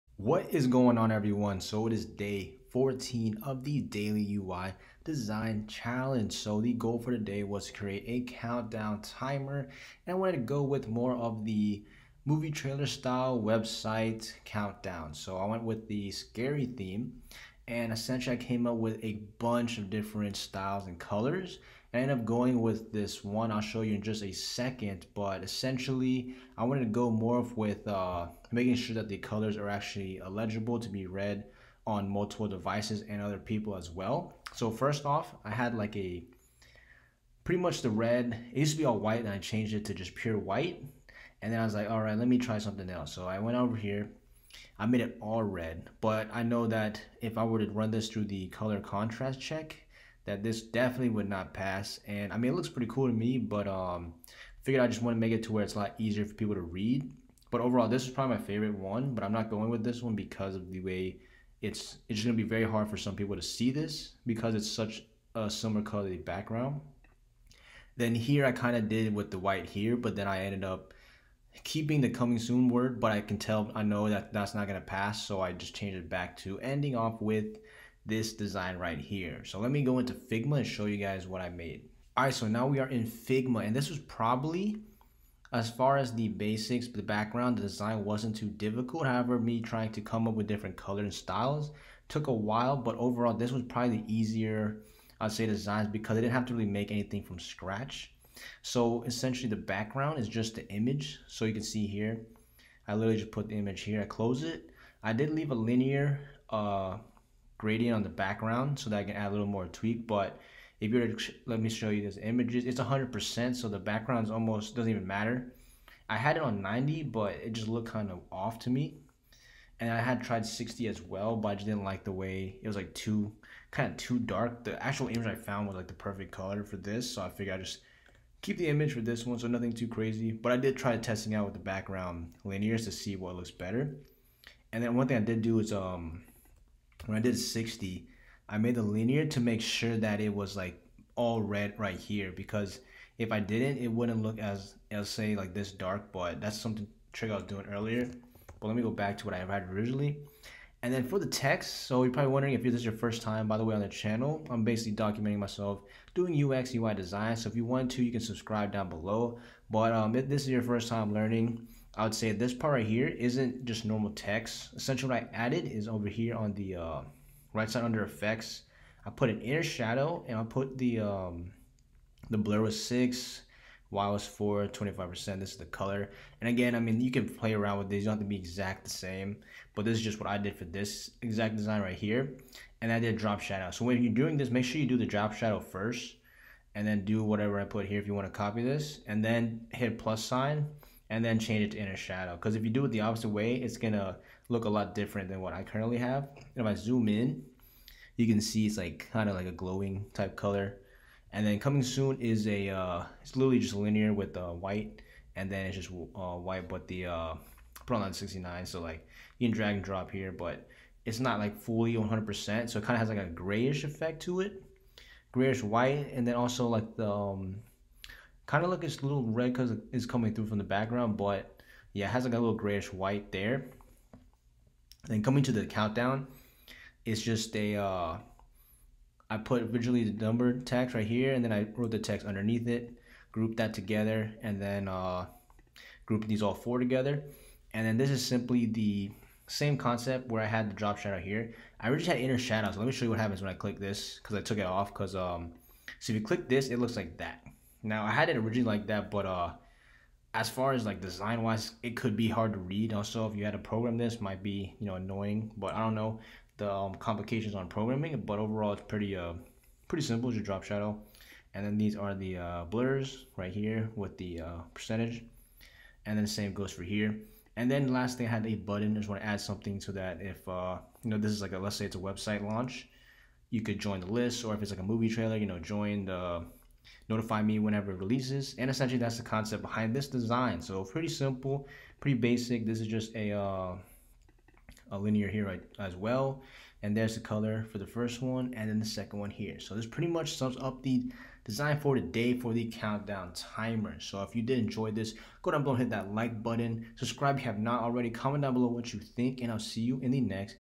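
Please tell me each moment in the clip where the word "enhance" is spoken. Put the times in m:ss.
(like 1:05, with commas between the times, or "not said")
not said.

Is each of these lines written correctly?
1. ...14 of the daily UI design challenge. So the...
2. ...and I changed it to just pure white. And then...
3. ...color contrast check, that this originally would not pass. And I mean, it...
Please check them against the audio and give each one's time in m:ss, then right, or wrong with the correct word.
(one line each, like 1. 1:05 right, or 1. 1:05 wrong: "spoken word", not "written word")
1. 0:02 right
2. 0:39 right
3. 0:48 wrong: "definitely", not "originally".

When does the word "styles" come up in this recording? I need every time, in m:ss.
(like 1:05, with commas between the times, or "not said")
0:12, 0:20, 1:31.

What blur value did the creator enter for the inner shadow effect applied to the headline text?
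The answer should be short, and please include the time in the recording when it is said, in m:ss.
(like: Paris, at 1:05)
6, at 2:52.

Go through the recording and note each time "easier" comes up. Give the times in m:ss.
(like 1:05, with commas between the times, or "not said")
0:55, 1:34.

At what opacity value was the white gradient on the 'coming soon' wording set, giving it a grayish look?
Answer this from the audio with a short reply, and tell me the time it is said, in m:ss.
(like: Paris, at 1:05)
69, at 3:28.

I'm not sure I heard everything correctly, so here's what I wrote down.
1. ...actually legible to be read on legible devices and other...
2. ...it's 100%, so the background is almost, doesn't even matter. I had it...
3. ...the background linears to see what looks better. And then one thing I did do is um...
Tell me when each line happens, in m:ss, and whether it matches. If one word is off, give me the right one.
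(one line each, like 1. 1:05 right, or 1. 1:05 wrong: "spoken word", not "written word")
1. 0:29 wrong: "multiple", not "legible"
2. 1:52 right
3. 2:11 right.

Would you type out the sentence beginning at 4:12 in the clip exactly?
Also, if you had to program this, might be you know annoying.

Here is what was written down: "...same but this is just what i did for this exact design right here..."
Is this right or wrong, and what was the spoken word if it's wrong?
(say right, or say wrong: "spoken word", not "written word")
right.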